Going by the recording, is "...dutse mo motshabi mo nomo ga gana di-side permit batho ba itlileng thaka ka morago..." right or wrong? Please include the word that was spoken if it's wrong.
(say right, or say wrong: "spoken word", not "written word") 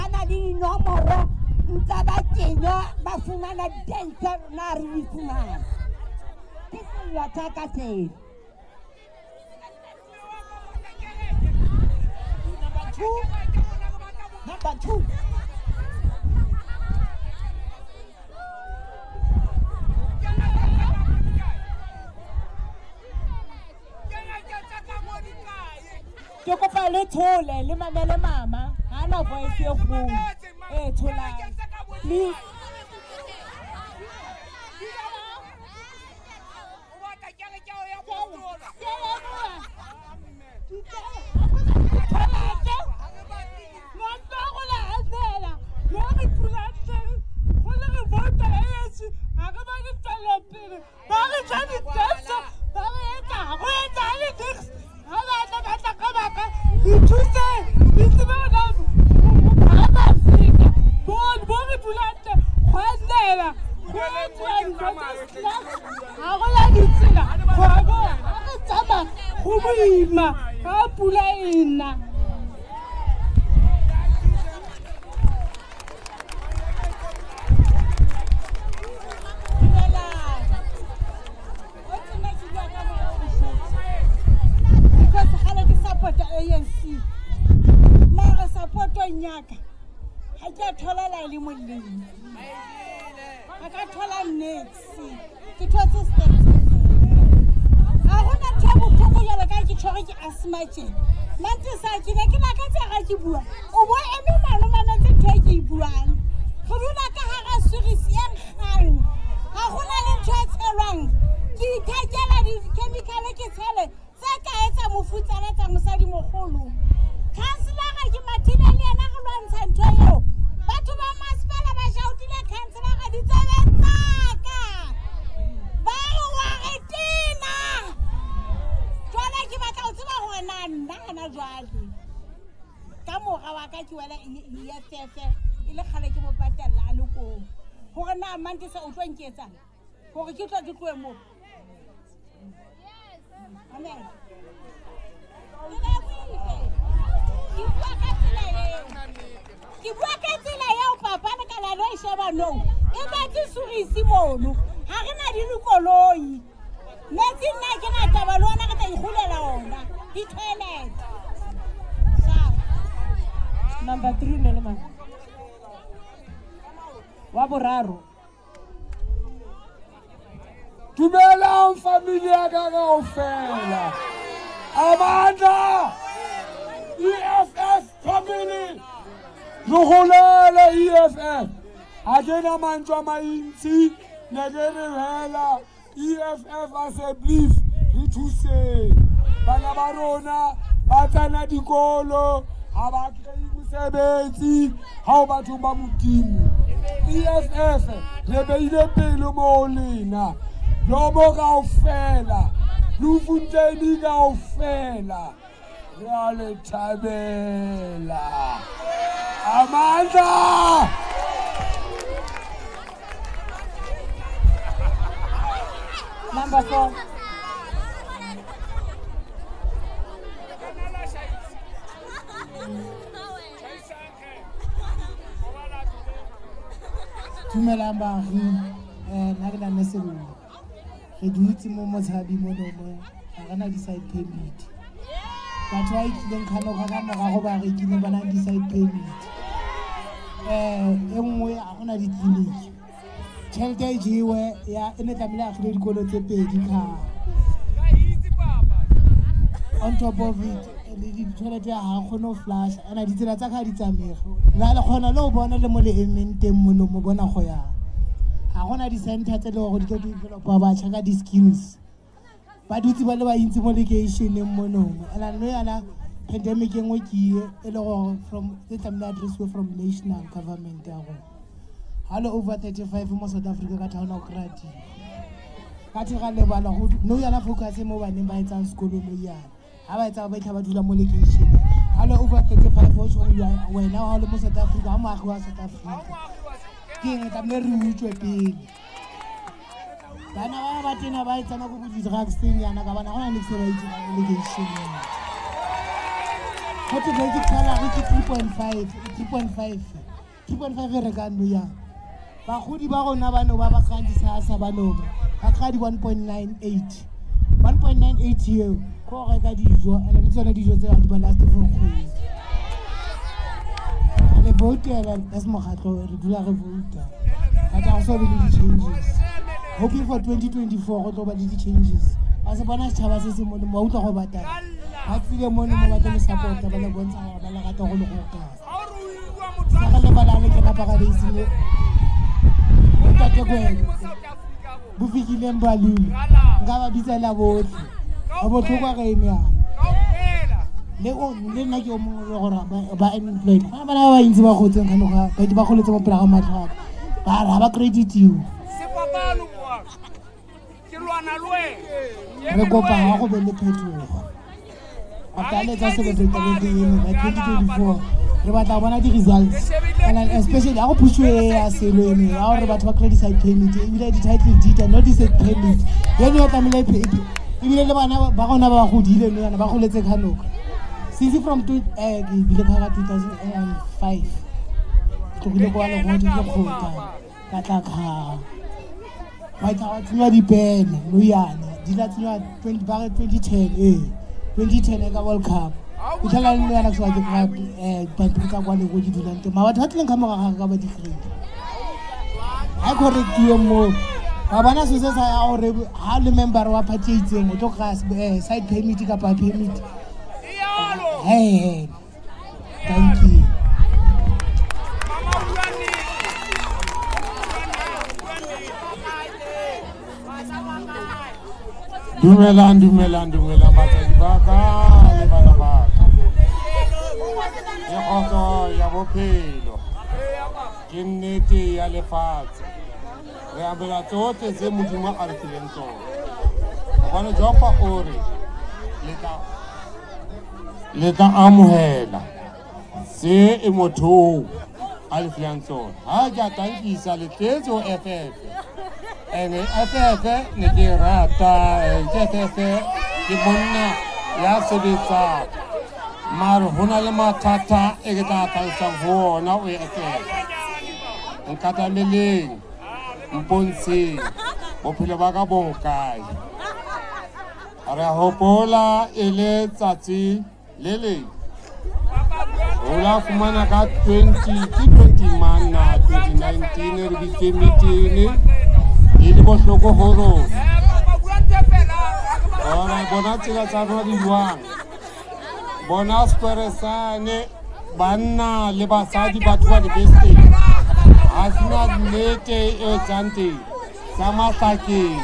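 wrong: "kganoka", not "thaka".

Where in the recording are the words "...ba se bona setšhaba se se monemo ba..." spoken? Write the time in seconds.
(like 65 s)
322 s.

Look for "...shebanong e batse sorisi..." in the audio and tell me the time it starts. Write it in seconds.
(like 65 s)
152 s.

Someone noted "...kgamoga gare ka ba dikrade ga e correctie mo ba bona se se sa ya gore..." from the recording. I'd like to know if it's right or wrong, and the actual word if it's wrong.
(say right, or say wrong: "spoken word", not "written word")
right.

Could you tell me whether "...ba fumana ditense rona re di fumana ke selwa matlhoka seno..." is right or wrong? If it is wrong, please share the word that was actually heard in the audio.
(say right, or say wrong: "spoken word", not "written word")
wrong: "thaka", not "matlhoka".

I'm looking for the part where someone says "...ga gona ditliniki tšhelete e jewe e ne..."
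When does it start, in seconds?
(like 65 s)
241 s.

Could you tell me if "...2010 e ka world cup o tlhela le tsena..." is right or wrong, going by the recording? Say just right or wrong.
wrong.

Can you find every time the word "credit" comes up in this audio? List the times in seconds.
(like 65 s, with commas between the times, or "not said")
347 s, 362 s.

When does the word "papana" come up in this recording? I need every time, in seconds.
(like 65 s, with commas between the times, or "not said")
151 s.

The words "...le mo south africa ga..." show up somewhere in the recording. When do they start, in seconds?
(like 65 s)
284 s.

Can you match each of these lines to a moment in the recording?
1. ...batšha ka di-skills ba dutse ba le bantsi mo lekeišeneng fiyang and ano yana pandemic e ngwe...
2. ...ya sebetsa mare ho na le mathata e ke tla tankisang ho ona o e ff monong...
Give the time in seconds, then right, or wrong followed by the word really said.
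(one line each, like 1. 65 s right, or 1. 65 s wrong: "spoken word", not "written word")
1. 260 s wrong: "monong", not "fiyang"
2. 444 s wrong: "nkatameleng", not "monong".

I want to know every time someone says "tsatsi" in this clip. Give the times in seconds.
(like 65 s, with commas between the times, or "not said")
459 s.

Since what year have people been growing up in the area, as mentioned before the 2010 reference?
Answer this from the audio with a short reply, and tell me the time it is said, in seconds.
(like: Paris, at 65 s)
2005, at 372 s.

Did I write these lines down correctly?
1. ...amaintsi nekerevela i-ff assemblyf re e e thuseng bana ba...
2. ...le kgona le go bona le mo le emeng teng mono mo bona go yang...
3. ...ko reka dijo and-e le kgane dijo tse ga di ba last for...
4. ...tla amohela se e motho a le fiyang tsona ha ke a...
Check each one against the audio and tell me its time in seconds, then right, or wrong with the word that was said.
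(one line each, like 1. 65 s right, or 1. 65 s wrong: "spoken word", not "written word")
1. 183 s right
2. 254 s right
3. 309 s wrong: "tsone", not "kgane"
4. 431 s right.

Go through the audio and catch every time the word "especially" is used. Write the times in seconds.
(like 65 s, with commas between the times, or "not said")
360 s.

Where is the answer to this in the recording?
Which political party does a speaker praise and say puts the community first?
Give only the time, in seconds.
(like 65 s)
197 s.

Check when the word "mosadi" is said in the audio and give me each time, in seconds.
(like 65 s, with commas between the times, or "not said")
115 s.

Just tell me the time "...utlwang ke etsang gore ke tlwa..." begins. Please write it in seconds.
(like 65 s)
138 s.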